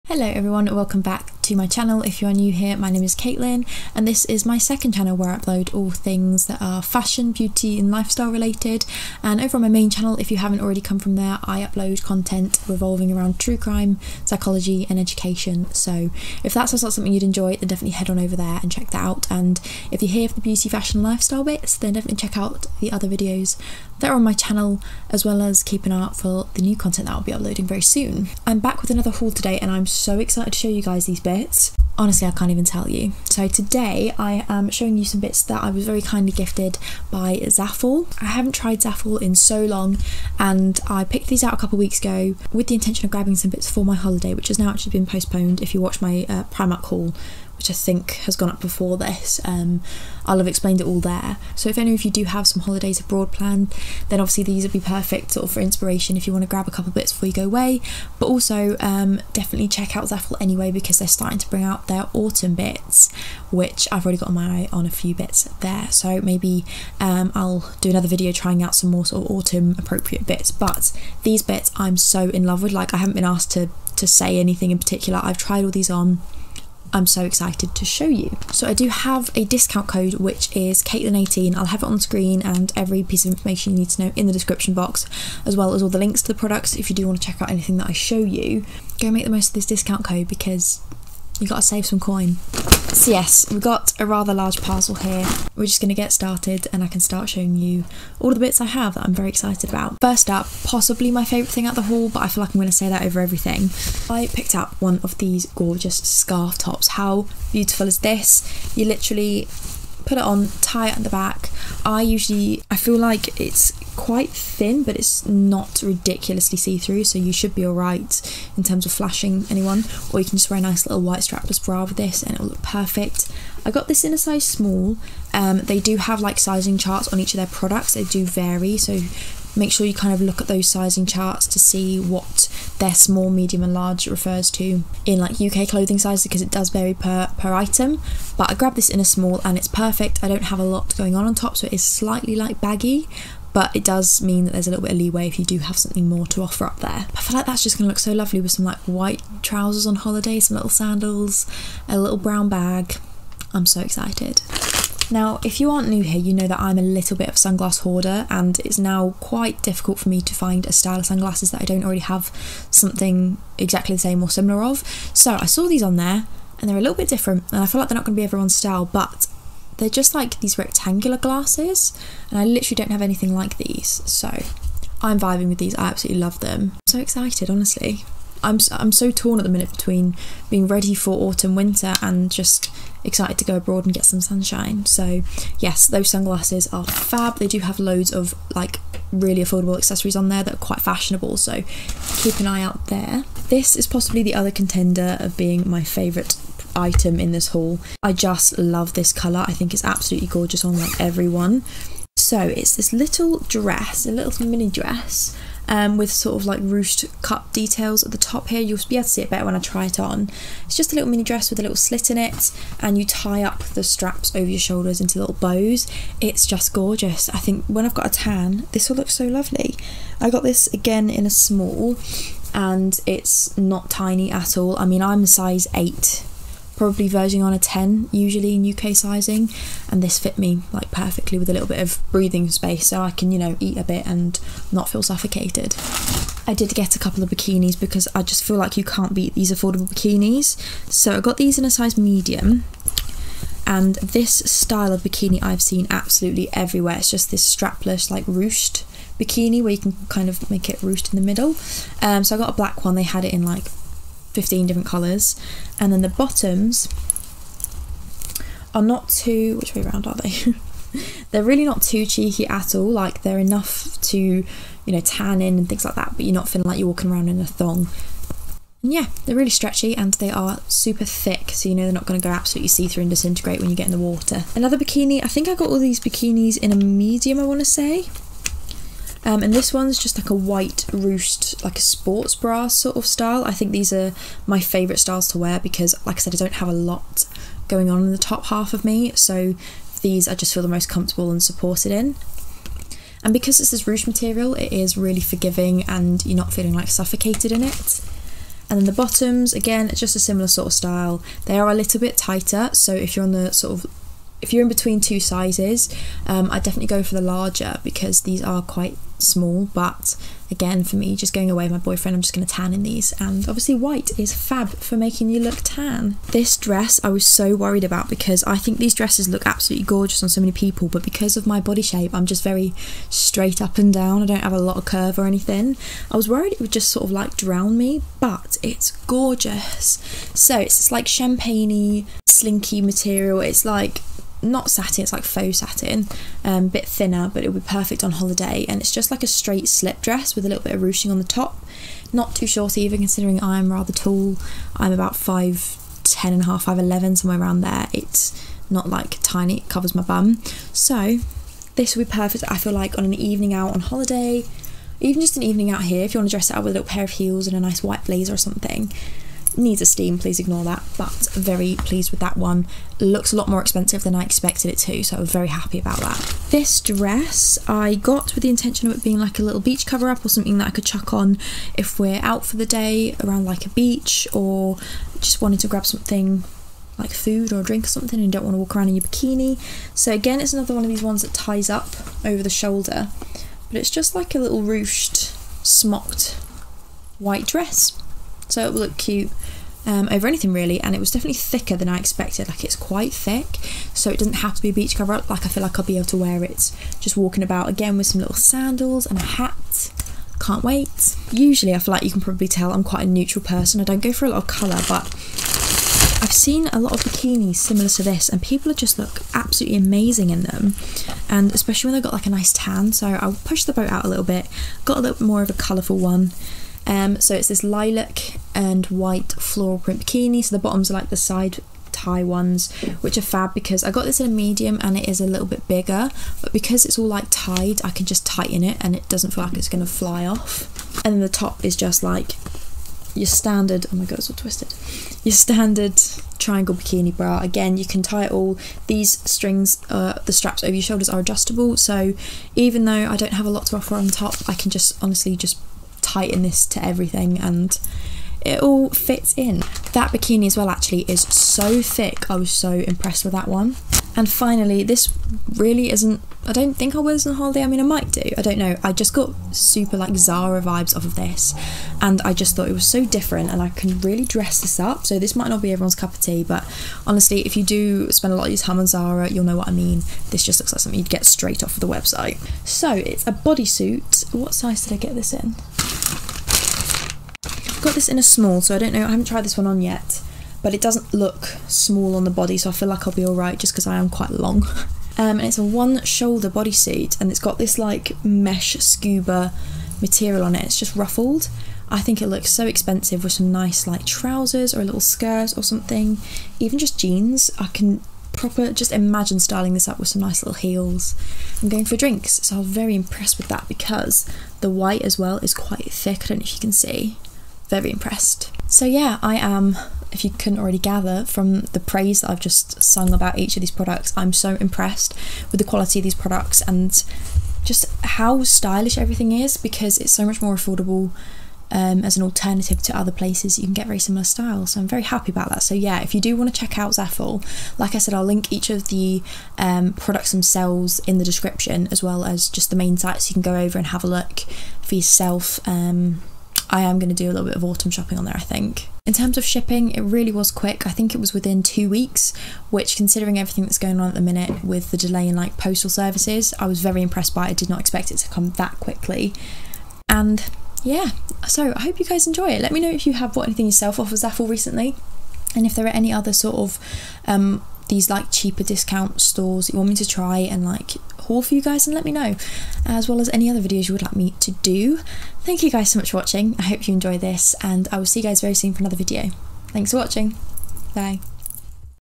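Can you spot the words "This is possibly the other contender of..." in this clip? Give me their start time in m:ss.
3:13.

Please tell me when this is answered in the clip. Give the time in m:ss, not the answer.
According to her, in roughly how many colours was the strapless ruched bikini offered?
4:14.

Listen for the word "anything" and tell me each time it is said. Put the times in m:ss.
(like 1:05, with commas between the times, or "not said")
1:14, 1:27, 2:53, 5:25, 6:30, 9:13.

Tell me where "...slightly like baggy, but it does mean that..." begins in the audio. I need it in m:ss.
2:21.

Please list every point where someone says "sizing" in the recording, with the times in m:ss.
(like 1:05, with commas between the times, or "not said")
2:06, 2:10, 3:48.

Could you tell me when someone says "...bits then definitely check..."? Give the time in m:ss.
0:21.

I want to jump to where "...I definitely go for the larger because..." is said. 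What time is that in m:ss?
5:06.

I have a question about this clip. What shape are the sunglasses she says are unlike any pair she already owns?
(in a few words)
rectangular.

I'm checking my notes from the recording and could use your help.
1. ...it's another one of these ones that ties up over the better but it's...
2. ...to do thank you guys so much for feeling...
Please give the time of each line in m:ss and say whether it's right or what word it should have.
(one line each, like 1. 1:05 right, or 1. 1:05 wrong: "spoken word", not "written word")
1. 6:20 wrong: "shoulder", not "better"
2. 9:24 wrong: "watching", not "feeling".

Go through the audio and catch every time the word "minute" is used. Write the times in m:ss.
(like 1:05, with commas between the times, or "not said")
2:59, 9:04.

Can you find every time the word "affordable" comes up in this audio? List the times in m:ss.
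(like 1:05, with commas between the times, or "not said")
3:09, 3:59, 8:40.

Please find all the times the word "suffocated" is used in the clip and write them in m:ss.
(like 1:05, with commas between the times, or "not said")
3:55, 4:56.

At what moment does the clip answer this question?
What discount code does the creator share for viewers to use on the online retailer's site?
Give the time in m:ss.
1:20.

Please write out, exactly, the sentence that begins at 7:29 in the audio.
That bikini as well actually is so thick.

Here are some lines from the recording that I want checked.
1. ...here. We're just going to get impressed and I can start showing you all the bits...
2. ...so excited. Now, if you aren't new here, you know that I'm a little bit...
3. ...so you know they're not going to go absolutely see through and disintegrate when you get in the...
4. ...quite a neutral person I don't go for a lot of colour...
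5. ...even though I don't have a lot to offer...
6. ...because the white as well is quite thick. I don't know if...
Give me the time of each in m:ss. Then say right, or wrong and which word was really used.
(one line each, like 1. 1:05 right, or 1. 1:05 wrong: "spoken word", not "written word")
1. 1:34 wrong: "started", not "impressed"
2. 2:33 right
3. 4:31 right
4. 6:42 right
5. 7:22 right
6. 8:23 right.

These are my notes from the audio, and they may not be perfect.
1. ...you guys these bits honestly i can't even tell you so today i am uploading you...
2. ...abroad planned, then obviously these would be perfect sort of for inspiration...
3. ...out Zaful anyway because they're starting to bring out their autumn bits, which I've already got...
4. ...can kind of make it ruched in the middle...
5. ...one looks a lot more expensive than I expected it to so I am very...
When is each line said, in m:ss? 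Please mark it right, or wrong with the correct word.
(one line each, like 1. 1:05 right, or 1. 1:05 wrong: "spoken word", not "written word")
1. 0:30 wrong: "showing", not "uploading"
2. 0:52 right
3. 0:59 right
4. 4:09 right
5. 6:02 right.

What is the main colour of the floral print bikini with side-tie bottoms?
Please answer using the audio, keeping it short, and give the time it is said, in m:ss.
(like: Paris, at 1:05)
lilac, at 6:57.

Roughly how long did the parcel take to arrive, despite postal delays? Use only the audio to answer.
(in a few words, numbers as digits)
two weeks.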